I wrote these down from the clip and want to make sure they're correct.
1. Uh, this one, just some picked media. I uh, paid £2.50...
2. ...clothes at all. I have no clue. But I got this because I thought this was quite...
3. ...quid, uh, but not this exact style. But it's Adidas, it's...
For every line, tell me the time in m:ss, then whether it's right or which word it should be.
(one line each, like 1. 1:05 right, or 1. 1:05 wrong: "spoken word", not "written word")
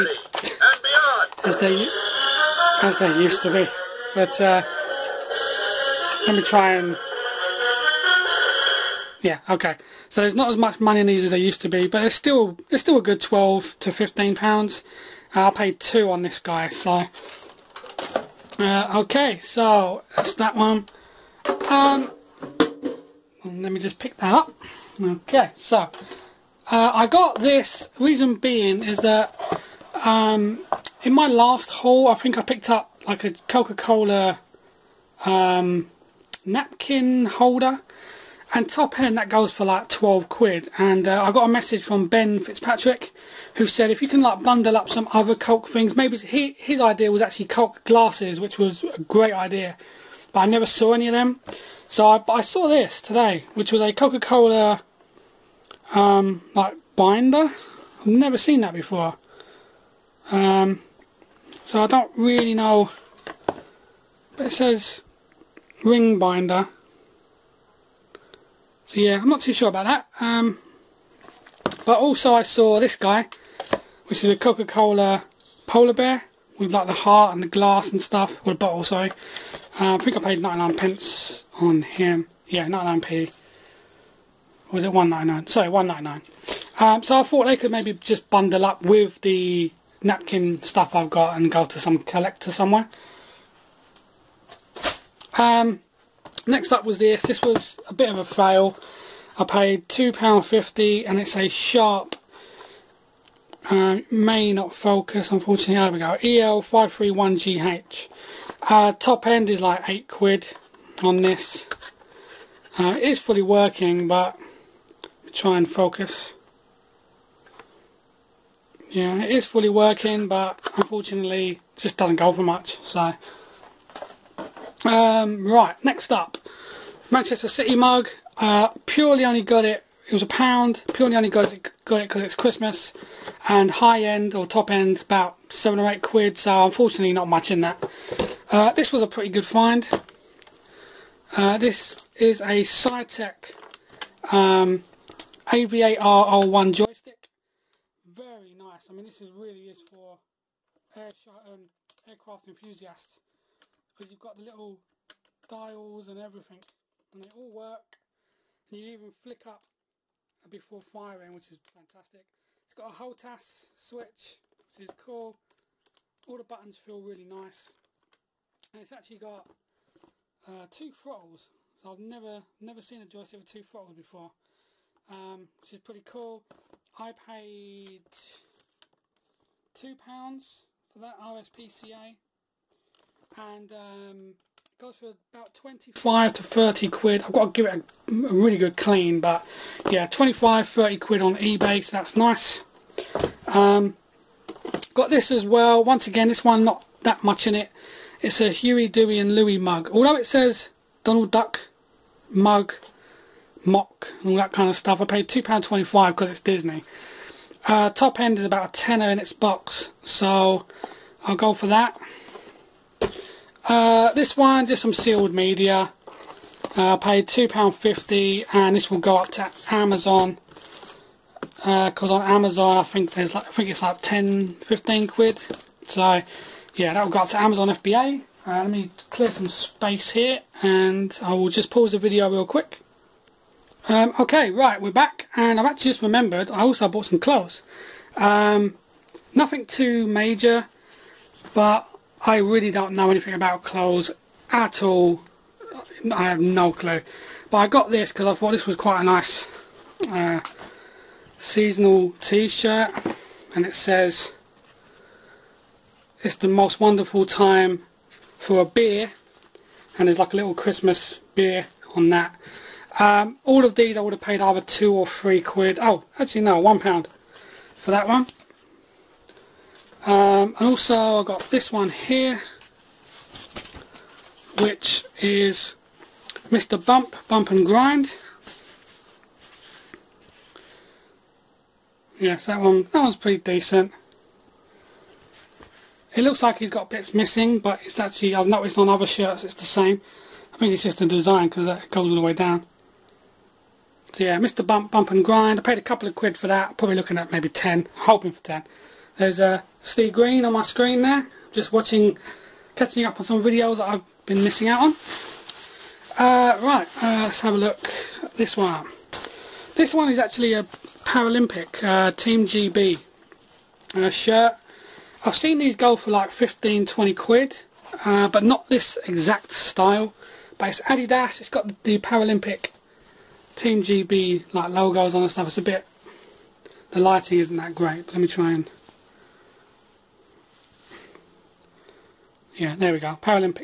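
1. 3:33 wrong: "sealed", not "picked"
2. 4:03 right
3. 5:17 right.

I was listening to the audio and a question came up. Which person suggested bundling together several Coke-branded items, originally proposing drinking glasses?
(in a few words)
Ben Fitzpatrick.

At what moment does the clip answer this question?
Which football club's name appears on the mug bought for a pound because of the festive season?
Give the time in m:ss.
2:07.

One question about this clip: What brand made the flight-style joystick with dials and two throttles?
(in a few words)
Saitek.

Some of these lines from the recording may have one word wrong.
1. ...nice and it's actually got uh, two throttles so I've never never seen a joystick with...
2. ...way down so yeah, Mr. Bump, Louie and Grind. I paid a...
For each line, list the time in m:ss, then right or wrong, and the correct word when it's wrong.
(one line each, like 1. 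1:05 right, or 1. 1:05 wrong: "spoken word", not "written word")
1. 2:47 right
2. 4:52 wrong: "Bump", not "Louie".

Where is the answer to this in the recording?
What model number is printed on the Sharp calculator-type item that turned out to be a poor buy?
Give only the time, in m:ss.
1:46.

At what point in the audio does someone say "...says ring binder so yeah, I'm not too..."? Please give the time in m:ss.
1:04.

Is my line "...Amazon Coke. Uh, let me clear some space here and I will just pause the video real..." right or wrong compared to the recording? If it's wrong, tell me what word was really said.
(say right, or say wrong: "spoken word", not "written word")
wrong: "FBA", not "Coke".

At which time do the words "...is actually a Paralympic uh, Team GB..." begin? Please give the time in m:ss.
5:10.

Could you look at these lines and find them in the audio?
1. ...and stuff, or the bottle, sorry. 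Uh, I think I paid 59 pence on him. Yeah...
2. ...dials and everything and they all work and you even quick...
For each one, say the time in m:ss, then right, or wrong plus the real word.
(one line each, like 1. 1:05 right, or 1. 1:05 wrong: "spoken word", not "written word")
1. 1:17 wrong: "99", not "59"
2. 2:35 wrong: "flick", not "quick".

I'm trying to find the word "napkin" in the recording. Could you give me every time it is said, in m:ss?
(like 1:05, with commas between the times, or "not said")
0:36, 1:30.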